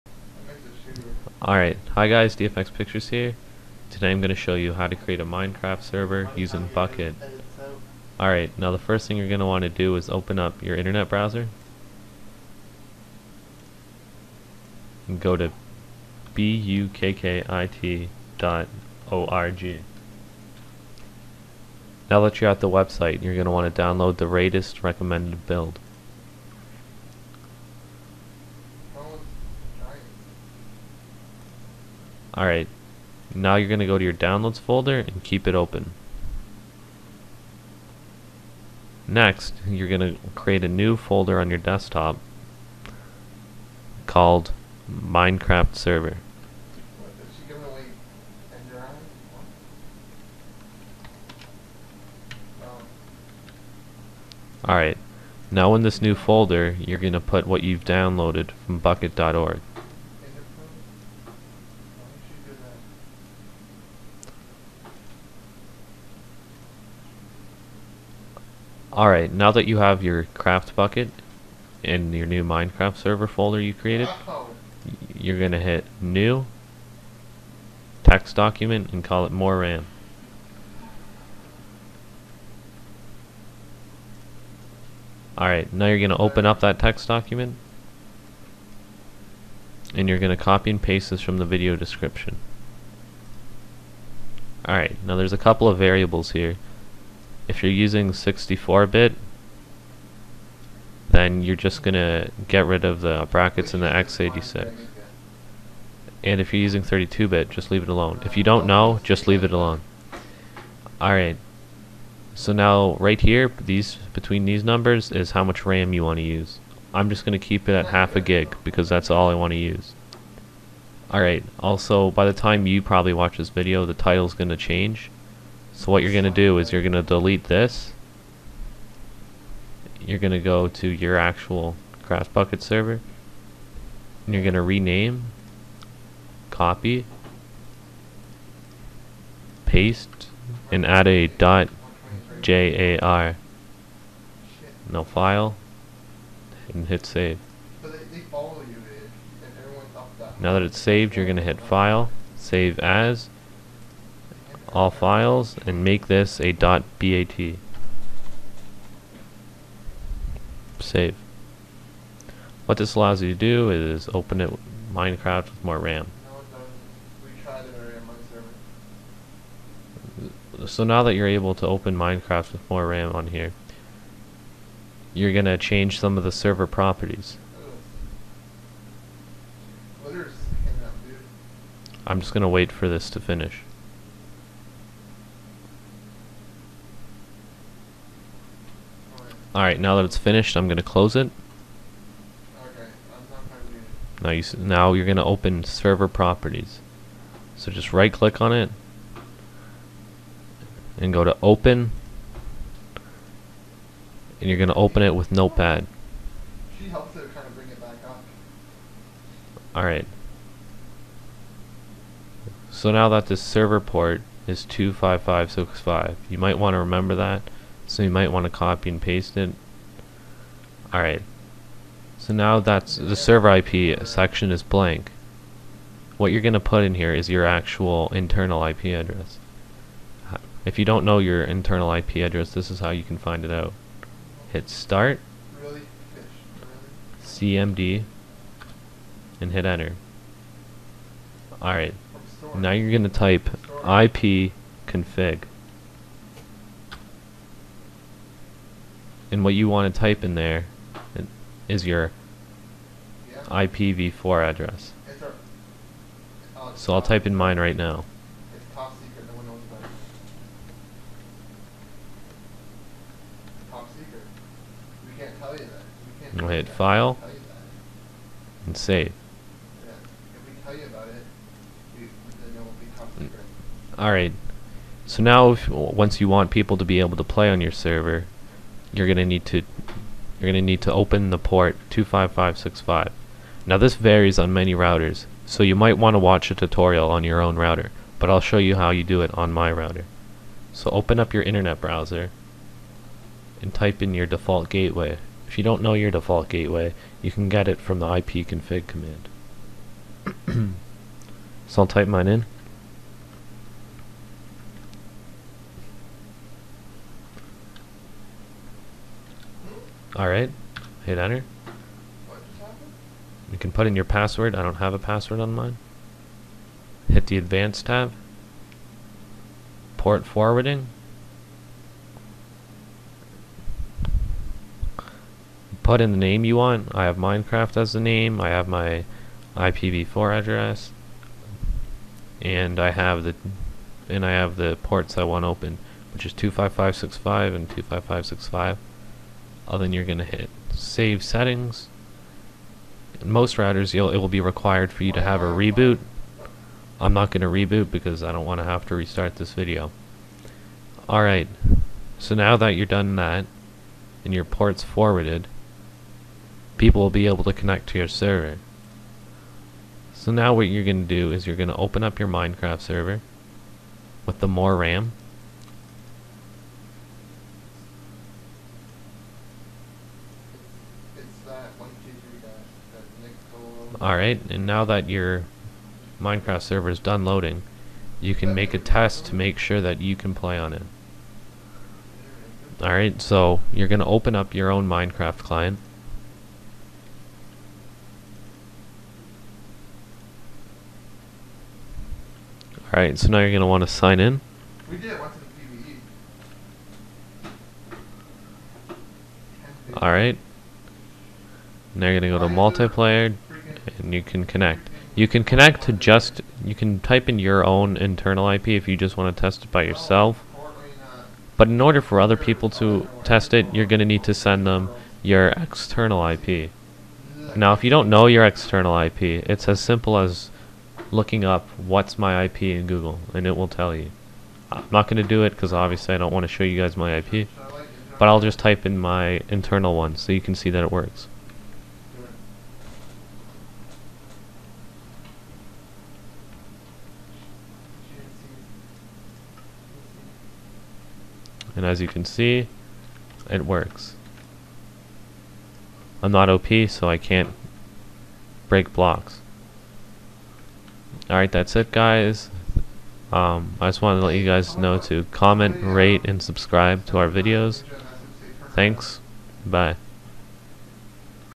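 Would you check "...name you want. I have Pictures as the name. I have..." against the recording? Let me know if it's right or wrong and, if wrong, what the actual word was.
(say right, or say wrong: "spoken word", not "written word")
wrong: "Minecraft", not "Pictures".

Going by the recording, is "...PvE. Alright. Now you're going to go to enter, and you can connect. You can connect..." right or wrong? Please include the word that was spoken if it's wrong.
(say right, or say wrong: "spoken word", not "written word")
wrong: "multiplayer", not "enter".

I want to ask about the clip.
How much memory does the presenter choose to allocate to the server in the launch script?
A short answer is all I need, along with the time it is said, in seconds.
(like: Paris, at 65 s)
half a gig, at 117 s.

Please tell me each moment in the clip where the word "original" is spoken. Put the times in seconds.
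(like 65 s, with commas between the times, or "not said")
not said.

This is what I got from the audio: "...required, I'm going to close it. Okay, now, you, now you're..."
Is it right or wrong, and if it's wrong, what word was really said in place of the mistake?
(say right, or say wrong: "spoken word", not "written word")
wrong: "finished", not "required".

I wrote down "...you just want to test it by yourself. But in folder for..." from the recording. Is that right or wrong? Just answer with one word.
wrong.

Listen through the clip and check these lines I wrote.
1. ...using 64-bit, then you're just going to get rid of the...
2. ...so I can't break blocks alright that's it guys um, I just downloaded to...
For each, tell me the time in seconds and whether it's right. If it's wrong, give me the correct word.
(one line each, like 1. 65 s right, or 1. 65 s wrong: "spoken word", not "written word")
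1. 97 s right
2. 446 s wrong: "wanted", not "downloaded".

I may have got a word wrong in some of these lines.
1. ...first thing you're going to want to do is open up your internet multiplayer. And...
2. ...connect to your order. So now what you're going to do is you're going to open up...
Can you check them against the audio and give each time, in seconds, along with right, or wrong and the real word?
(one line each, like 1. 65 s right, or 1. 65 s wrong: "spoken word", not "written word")
1. 8 s wrong: "browser", not "multiplayer"
2. 357 s wrong: "server", not "order".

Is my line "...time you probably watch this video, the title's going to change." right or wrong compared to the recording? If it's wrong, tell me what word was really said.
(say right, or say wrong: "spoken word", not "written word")
right.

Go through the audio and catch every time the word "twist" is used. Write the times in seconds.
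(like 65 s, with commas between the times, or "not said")
not said.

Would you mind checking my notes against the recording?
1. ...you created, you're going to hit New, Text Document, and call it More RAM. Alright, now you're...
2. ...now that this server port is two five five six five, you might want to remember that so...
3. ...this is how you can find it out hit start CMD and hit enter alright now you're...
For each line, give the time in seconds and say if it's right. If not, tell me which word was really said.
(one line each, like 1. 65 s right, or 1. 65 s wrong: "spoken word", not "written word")
1. 73 s right
2. 212 s right
3. 232 s right.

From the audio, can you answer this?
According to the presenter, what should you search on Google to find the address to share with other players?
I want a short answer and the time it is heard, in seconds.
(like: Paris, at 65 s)
what's my IP, at 421 s.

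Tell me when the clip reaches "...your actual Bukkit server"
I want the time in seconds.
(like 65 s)
130 s.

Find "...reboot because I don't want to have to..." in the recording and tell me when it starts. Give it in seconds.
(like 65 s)
347 s.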